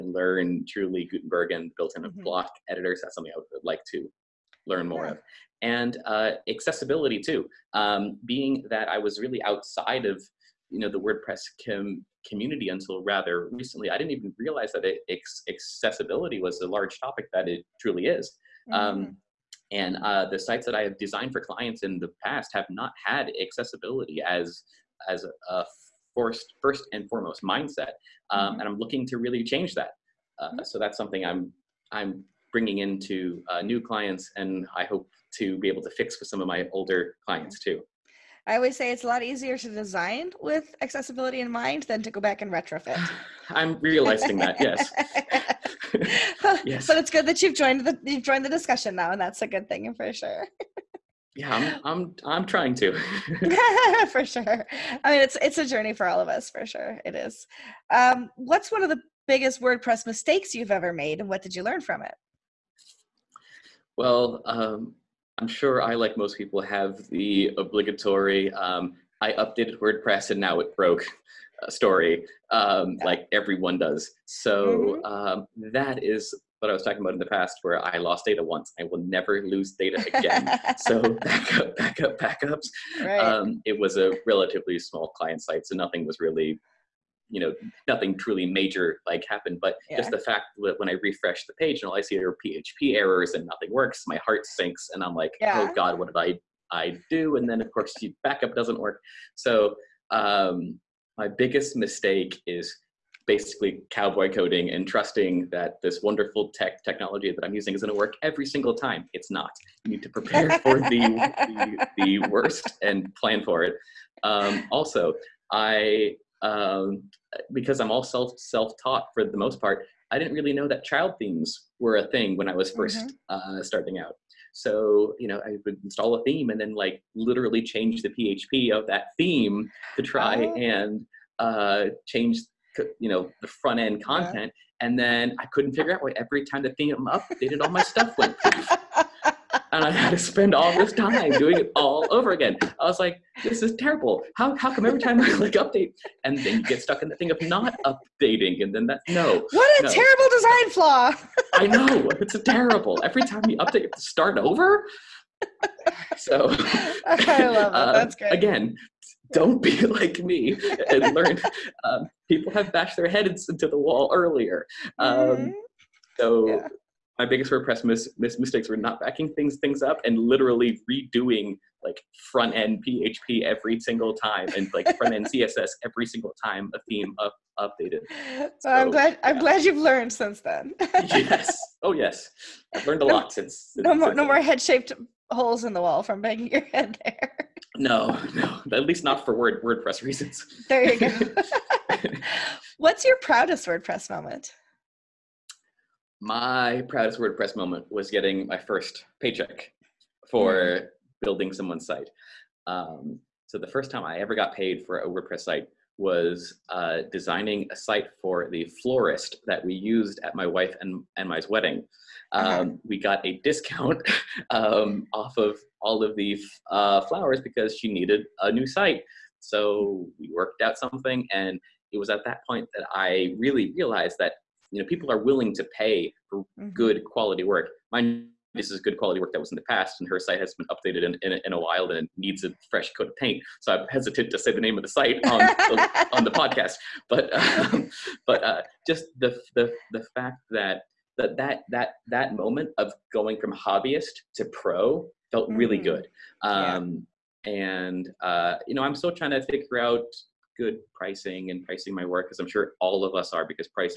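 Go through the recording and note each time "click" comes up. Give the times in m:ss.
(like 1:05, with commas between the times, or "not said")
2:25.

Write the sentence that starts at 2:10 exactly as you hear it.
and uh, change you know the front end content.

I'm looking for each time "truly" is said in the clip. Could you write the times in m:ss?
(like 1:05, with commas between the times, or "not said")
0:00, 0:17, 1:28.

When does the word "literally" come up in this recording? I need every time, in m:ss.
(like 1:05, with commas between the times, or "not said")
2:07, 2:50.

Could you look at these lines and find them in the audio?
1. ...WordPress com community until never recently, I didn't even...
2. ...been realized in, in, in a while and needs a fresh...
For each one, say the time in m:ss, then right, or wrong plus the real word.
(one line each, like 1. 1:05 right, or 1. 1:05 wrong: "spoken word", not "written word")
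1. 0:11 wrong: "rather", not "never"
2. 3:50 wrong: "updated", not "realized".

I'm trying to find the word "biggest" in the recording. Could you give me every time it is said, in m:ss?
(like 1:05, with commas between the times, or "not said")
0:59, 1:41, 2:47.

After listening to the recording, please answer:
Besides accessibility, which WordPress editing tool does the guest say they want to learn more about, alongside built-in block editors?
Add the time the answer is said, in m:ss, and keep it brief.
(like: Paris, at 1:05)
Gutenberg, at 0:01.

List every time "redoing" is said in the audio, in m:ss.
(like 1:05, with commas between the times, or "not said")
2:50.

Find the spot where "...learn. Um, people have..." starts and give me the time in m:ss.
2:41.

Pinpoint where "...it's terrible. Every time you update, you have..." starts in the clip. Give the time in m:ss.
2:32.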